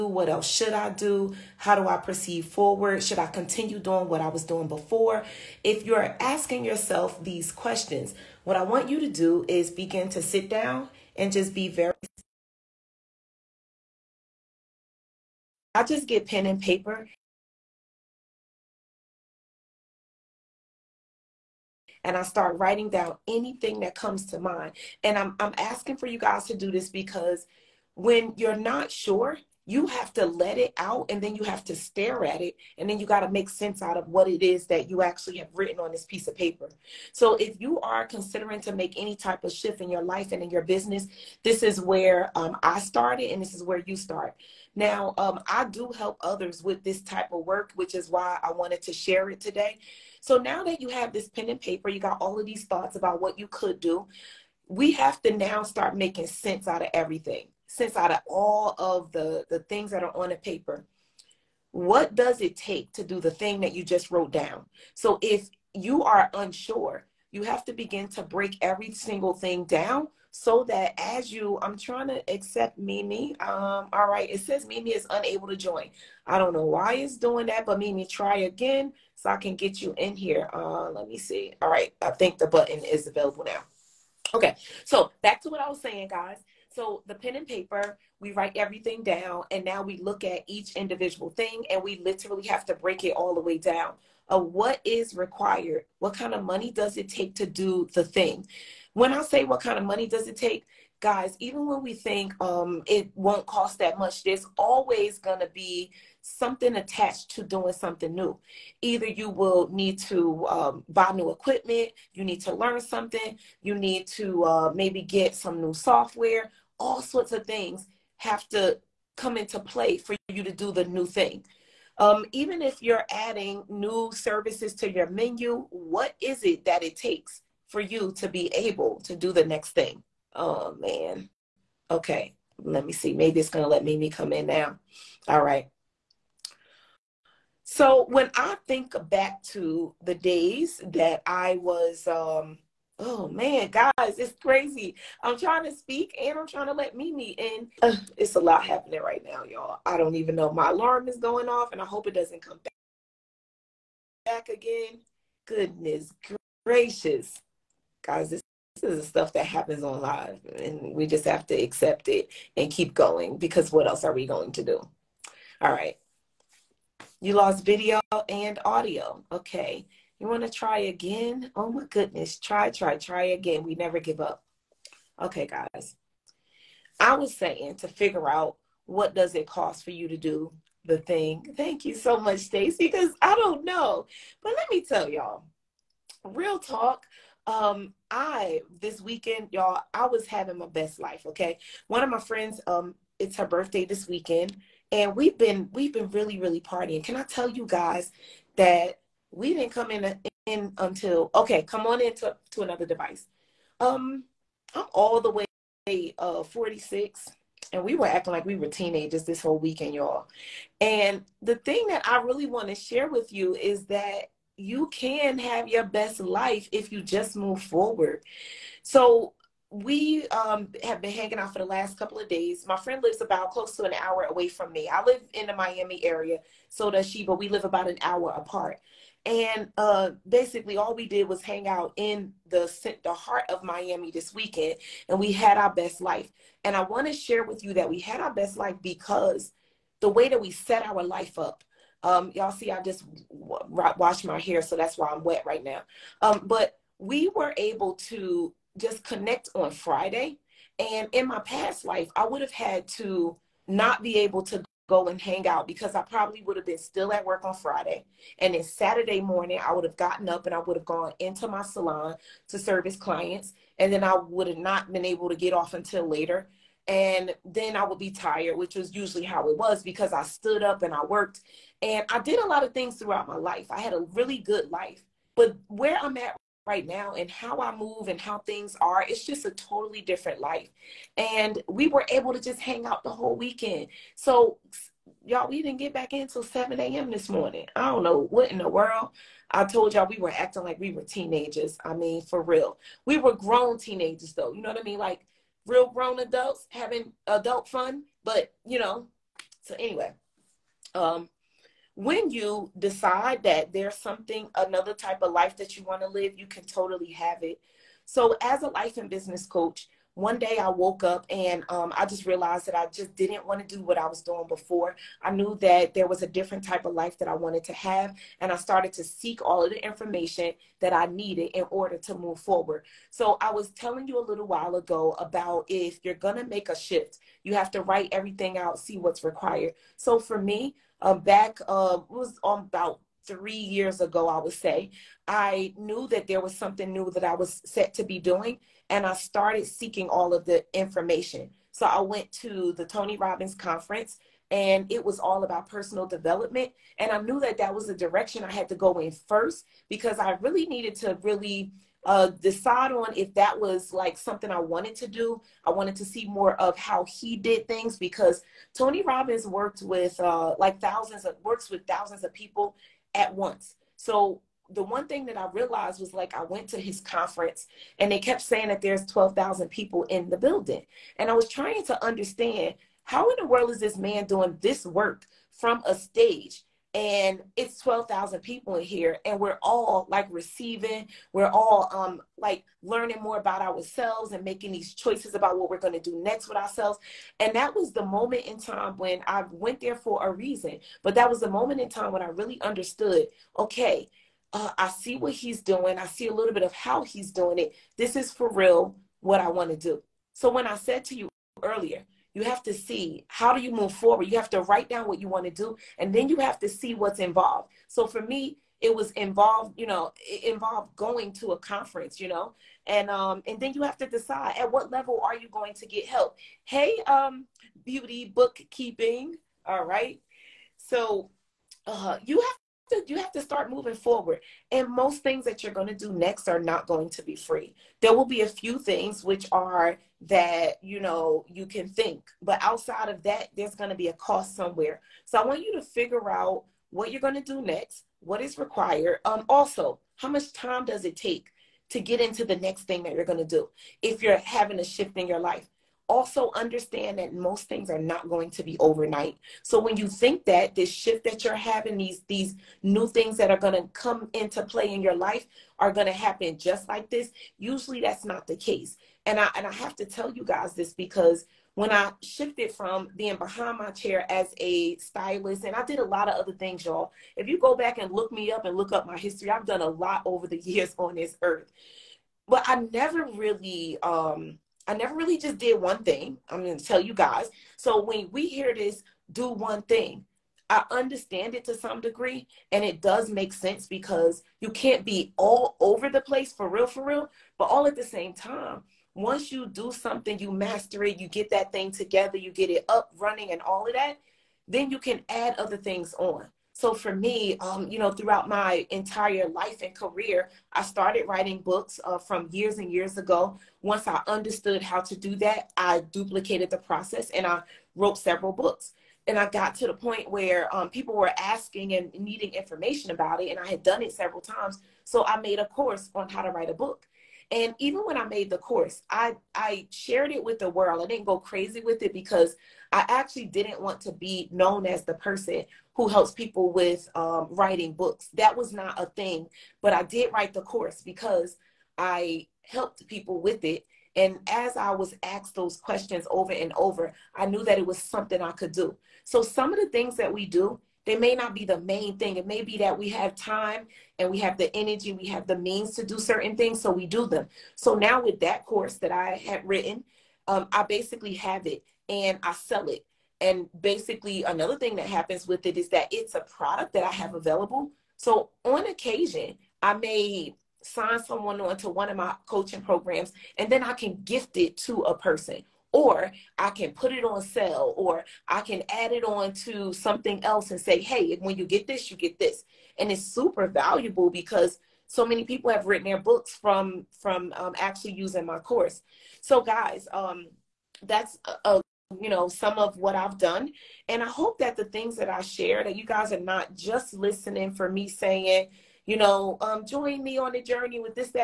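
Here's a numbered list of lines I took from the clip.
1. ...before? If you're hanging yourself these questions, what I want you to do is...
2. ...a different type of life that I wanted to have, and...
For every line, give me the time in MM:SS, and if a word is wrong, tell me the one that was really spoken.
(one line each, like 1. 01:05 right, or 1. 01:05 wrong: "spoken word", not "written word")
1. 00:04 wrong: "asking", not "hanging"
2. 05:16 right.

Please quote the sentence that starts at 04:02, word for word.
Um, y'all see, I just washed my hair, so that's why I'm wet right now.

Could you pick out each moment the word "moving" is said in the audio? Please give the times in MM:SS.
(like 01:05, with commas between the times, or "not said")
07:03.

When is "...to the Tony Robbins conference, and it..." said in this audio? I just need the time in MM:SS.
05:42.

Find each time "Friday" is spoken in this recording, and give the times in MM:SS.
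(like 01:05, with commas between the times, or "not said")
04:09, 04:17.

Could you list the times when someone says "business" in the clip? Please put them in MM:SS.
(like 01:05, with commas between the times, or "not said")
00:40, 05:09.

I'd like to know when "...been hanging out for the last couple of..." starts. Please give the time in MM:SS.
03:40.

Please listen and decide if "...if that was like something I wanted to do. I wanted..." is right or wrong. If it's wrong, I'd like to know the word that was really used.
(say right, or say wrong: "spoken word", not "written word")
right.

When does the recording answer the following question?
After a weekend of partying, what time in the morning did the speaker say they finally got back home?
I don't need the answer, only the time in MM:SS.
04:46.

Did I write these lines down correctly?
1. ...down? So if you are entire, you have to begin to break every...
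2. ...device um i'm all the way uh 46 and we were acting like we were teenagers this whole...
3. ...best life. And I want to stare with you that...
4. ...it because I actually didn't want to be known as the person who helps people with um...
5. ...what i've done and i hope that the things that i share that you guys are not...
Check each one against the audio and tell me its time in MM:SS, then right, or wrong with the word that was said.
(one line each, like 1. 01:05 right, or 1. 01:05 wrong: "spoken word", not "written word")
1. 01:04 wrong: "unsure", not "entire"
2. 03:22 right
3. 03:55 wrong: "share", not "stare"
4. 08:42 right
5. 09:42 right.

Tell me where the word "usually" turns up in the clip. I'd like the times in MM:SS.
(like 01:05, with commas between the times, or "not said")
04:28, 07:37.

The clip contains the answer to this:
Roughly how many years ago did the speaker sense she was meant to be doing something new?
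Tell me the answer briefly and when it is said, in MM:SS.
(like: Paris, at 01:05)
3, at 05:33.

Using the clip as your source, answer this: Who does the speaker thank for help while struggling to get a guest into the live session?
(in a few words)
Stacy.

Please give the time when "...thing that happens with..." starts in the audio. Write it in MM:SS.
09:14.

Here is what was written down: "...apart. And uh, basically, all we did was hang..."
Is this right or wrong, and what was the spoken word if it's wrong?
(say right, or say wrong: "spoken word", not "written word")
right.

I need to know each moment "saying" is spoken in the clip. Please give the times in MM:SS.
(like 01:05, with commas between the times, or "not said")
01:25, 02:57, 06:08, 09:48.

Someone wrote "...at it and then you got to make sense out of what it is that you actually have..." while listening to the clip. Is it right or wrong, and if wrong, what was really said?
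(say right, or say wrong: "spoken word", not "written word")
right.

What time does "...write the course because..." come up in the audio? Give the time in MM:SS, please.
08:50.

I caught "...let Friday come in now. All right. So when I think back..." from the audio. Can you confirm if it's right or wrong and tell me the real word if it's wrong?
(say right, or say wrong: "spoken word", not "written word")
wrong: "Mimi", not "Friday".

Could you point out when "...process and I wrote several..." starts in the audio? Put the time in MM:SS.
08:26.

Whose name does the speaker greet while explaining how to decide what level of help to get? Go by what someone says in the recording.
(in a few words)
Beauty bookkeeping.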